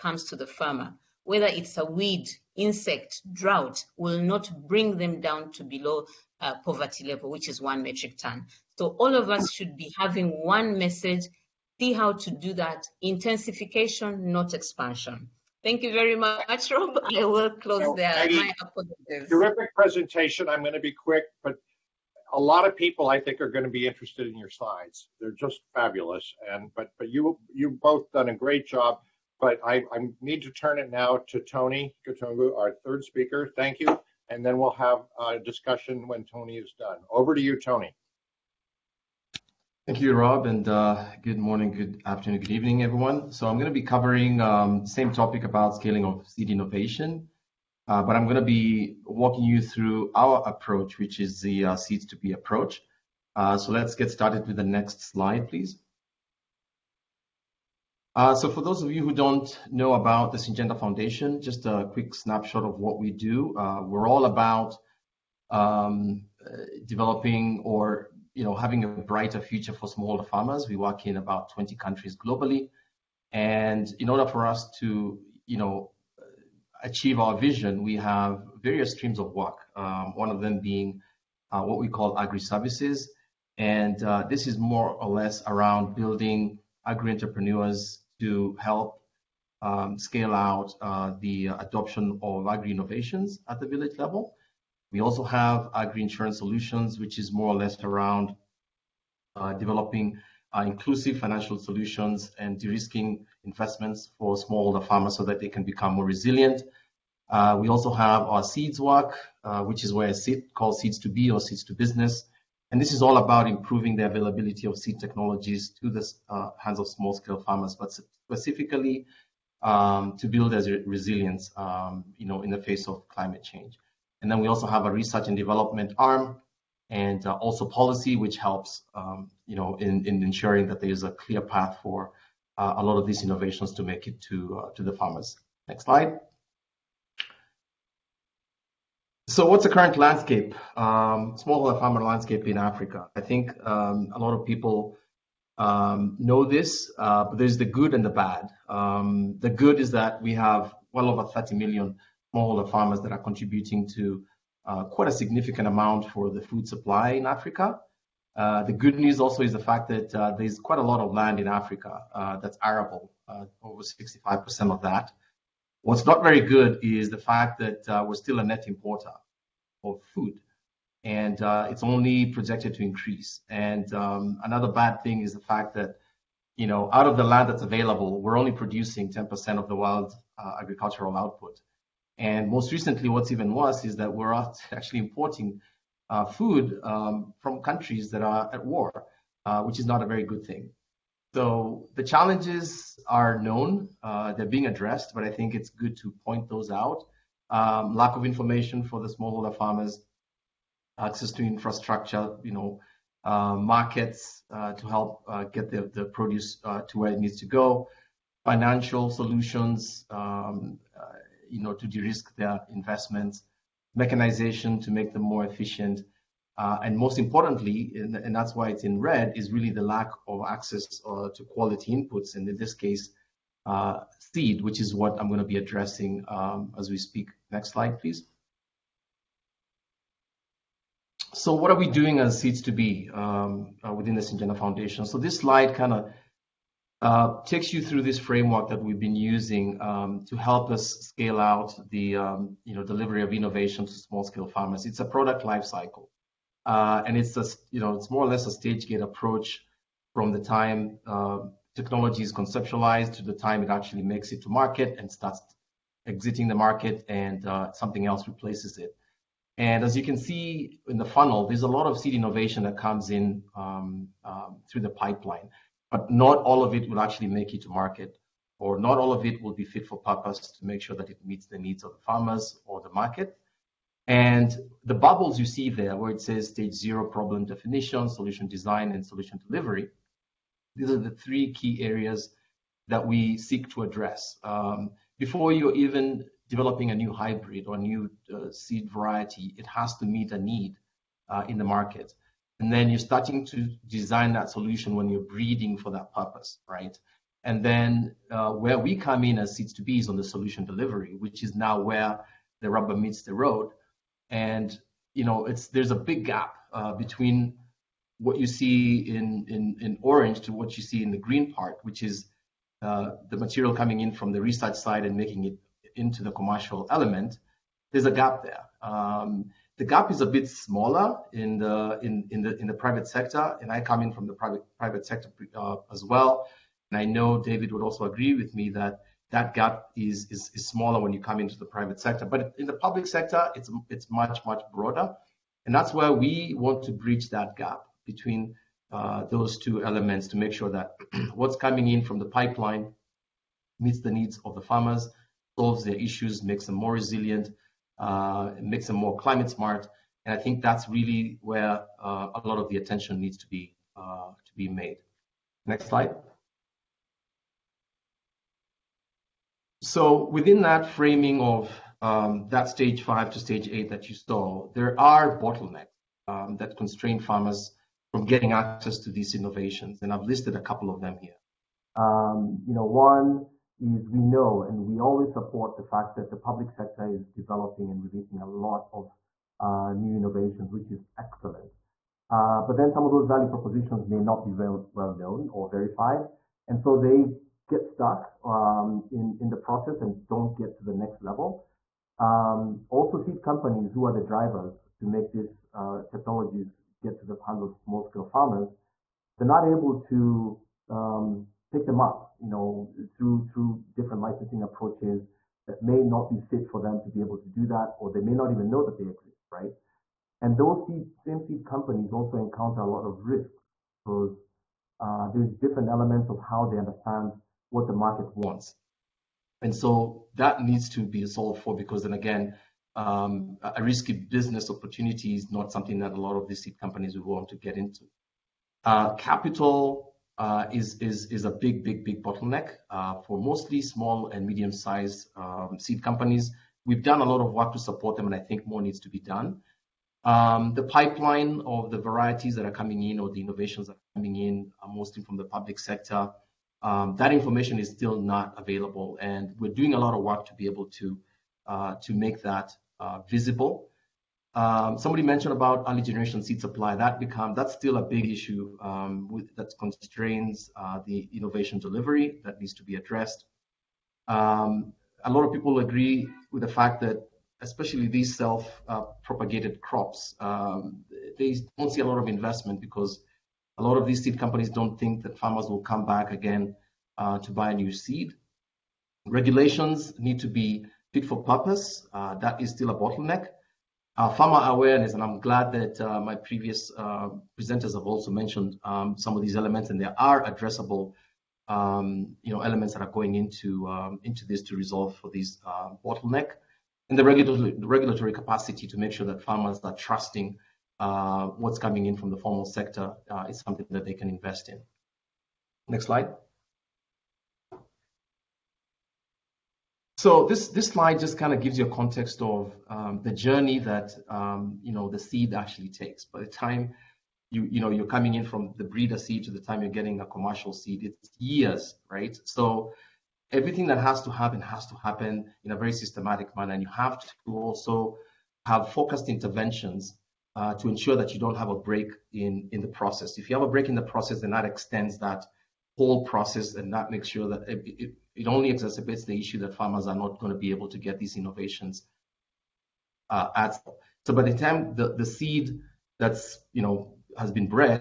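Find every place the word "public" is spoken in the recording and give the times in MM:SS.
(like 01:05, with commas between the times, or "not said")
05:32, 06:16, 07:25.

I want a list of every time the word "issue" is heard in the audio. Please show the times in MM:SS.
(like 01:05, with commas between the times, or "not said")
05:45, 07:38, 08:59.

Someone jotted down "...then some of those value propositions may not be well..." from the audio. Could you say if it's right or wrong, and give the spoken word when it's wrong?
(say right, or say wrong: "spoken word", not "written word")
right.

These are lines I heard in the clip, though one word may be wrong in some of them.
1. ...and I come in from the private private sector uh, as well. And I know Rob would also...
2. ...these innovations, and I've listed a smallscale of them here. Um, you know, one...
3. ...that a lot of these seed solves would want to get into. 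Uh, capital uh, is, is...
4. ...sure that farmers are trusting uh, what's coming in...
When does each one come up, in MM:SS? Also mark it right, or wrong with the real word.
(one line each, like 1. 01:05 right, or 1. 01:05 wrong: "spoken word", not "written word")
1. 05:23 wrong: "David", not "Rob"
2. 06:09 wrong: "couple", not "smallscale"
3. 07:05 wrong: "companies", not "solves"
4. 08:19 right.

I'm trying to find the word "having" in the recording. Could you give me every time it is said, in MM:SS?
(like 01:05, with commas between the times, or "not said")
00:09, 01:08.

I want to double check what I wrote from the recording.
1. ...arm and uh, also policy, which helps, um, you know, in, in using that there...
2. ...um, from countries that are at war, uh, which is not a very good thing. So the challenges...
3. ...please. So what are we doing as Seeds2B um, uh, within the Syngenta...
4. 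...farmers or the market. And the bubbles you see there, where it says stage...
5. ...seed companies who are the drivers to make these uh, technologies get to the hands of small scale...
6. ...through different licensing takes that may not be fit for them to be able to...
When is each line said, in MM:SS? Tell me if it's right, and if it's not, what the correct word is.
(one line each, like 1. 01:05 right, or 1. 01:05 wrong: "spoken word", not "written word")
1. 02:05 wrong: "ensuring", not "using"
2. 03:06 right
3. 03:47 right
4. 04:31 right
5. 06:33 right
6. 06:43 wrong: "approaches", not "takes".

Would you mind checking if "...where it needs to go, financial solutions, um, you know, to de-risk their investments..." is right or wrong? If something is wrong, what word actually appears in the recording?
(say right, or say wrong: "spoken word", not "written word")
right.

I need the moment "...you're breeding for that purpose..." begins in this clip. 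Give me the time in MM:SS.
04:55.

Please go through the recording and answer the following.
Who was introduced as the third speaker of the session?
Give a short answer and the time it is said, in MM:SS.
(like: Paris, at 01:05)
Tony Katungu, at 00:31.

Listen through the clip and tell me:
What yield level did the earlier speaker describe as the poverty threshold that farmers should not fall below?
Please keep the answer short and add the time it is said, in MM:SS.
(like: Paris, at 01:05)
1 metric ton, at 00:07.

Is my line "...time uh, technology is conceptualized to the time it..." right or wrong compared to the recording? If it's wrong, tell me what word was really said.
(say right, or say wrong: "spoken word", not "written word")
right.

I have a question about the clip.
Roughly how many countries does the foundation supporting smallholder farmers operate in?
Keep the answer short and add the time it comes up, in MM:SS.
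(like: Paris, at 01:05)
About 20, at 01:11.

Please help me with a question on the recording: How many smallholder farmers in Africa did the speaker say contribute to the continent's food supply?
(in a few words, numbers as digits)
Over 30 million.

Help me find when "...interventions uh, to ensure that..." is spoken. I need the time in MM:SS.
08:49.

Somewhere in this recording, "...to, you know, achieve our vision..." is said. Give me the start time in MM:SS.
01:14.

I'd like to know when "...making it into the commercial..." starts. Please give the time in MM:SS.
05:15.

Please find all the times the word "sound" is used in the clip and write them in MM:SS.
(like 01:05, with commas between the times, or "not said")
not said.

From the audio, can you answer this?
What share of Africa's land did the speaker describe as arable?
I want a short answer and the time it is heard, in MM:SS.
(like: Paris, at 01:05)
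Over 65%, at 02:43.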